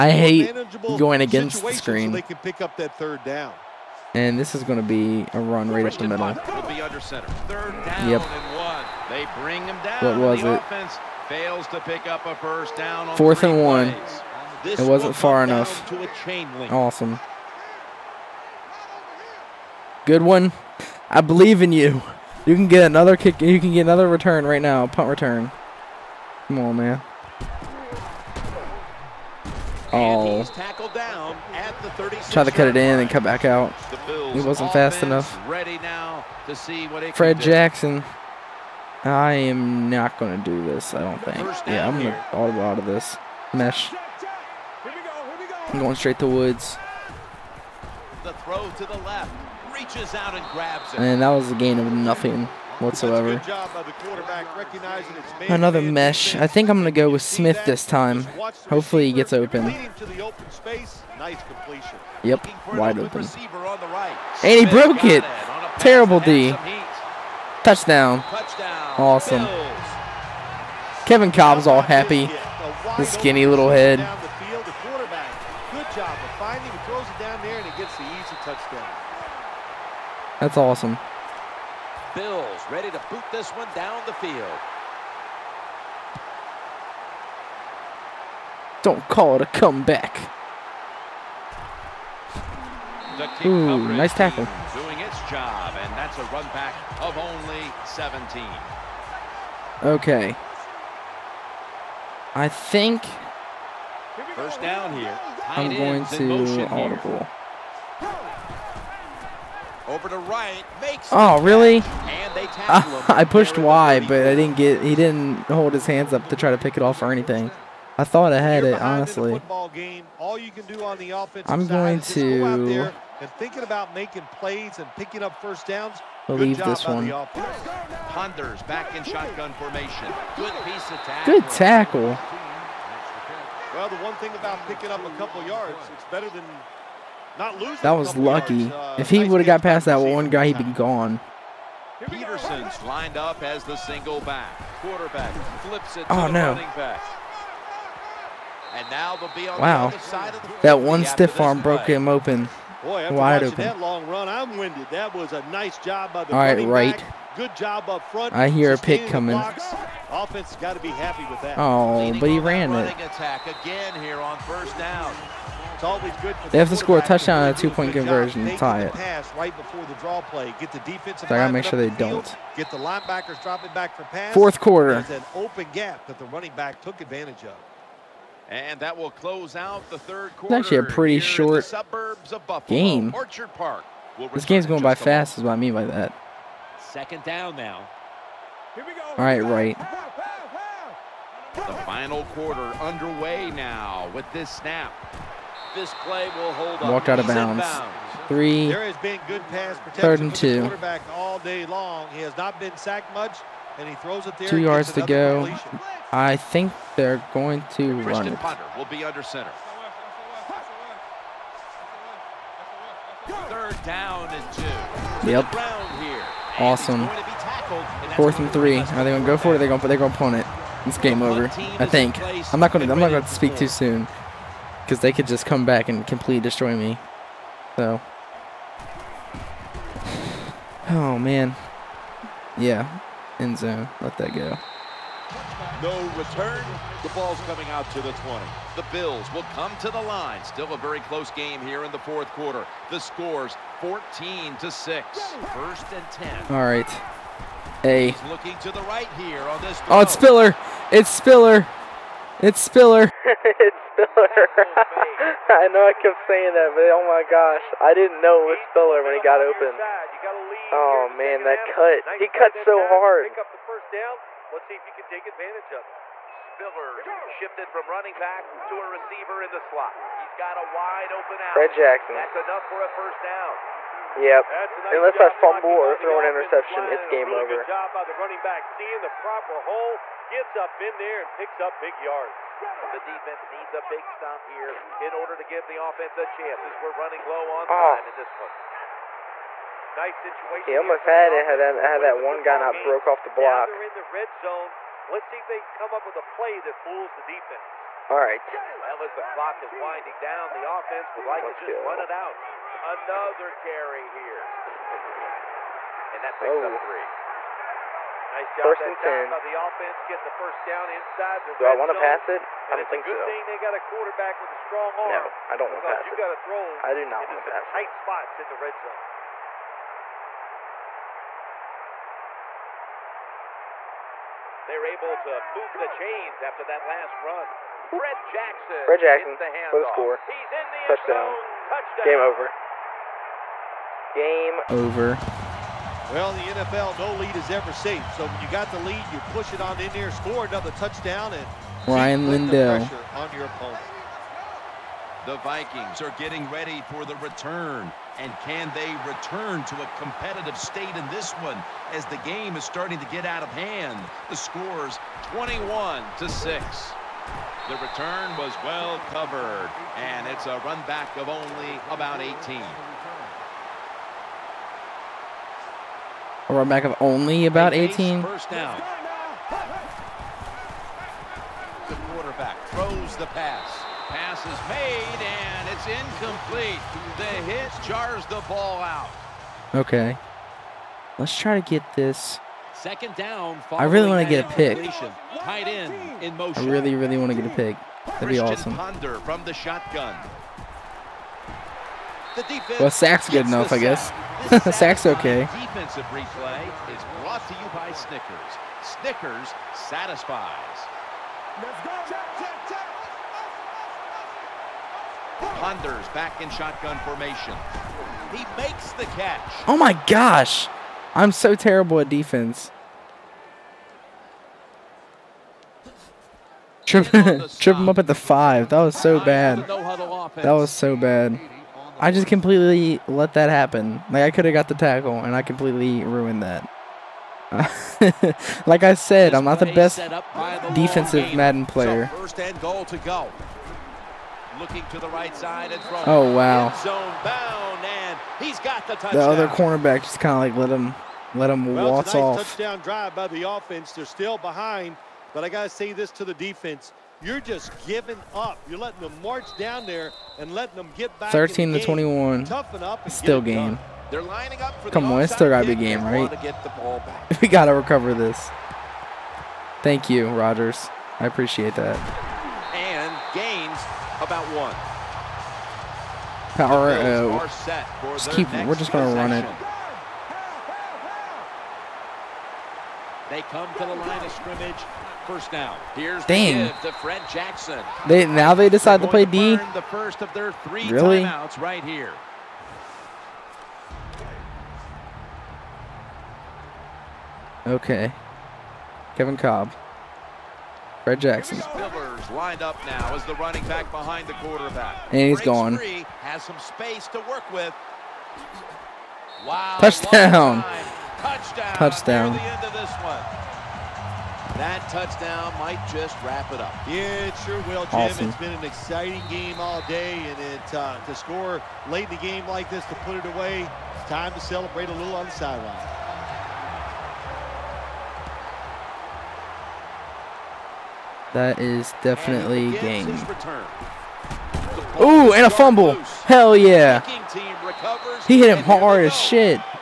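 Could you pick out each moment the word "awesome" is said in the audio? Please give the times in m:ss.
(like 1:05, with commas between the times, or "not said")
0:16, 1:08, 1:20, 3:36, 6:28, 8:27.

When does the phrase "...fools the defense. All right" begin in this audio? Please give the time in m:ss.
4:56.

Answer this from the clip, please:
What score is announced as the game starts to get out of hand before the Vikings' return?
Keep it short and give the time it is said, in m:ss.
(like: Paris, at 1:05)
21 to 6, at 5:54.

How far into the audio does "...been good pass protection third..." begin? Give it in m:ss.
3:18.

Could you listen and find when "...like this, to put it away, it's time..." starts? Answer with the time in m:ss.
8:32.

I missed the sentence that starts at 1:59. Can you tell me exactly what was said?
Game, I'm going to and thinking about making plays and picking up first downs.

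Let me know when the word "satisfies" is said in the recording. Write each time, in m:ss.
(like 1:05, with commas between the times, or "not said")
6:39.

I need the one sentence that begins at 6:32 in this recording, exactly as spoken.
The well, sack's good enough, I guess.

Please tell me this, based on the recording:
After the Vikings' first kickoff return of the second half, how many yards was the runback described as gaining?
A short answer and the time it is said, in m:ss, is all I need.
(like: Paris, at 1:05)
17, at 1:36.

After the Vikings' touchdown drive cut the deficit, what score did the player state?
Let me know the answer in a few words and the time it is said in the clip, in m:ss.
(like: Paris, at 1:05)
13 to 21, at 7:31.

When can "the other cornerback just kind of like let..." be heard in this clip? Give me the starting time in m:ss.
7:19.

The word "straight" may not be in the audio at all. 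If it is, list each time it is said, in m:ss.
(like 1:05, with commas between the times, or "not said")
0:45.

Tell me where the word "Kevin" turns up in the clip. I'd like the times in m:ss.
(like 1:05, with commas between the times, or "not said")
1:11, 8:09.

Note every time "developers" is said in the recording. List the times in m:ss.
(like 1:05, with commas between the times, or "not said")
not said.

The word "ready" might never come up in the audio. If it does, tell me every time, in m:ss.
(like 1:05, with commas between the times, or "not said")
1:22, 5:46.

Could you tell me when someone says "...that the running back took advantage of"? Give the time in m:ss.
2:56.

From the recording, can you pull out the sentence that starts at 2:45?
They have to score a touchdown and a two-point conversion to tie it.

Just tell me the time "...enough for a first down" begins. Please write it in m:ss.
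4:32.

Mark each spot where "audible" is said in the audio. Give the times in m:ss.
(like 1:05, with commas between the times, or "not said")
0:42, 1:46.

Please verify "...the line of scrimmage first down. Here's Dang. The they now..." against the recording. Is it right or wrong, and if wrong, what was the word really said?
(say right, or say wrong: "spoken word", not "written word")
right.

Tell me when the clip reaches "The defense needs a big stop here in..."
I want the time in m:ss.
4:42.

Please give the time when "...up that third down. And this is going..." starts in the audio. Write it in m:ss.
0:02.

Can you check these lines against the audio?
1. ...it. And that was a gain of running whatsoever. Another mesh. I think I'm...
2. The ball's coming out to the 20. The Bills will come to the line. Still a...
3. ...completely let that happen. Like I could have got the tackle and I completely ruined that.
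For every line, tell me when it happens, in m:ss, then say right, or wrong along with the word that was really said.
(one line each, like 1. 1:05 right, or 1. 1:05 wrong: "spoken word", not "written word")
1. 0:50 wrong: "nothing", not "running"
2. 3:57 right
3. 7:02 right.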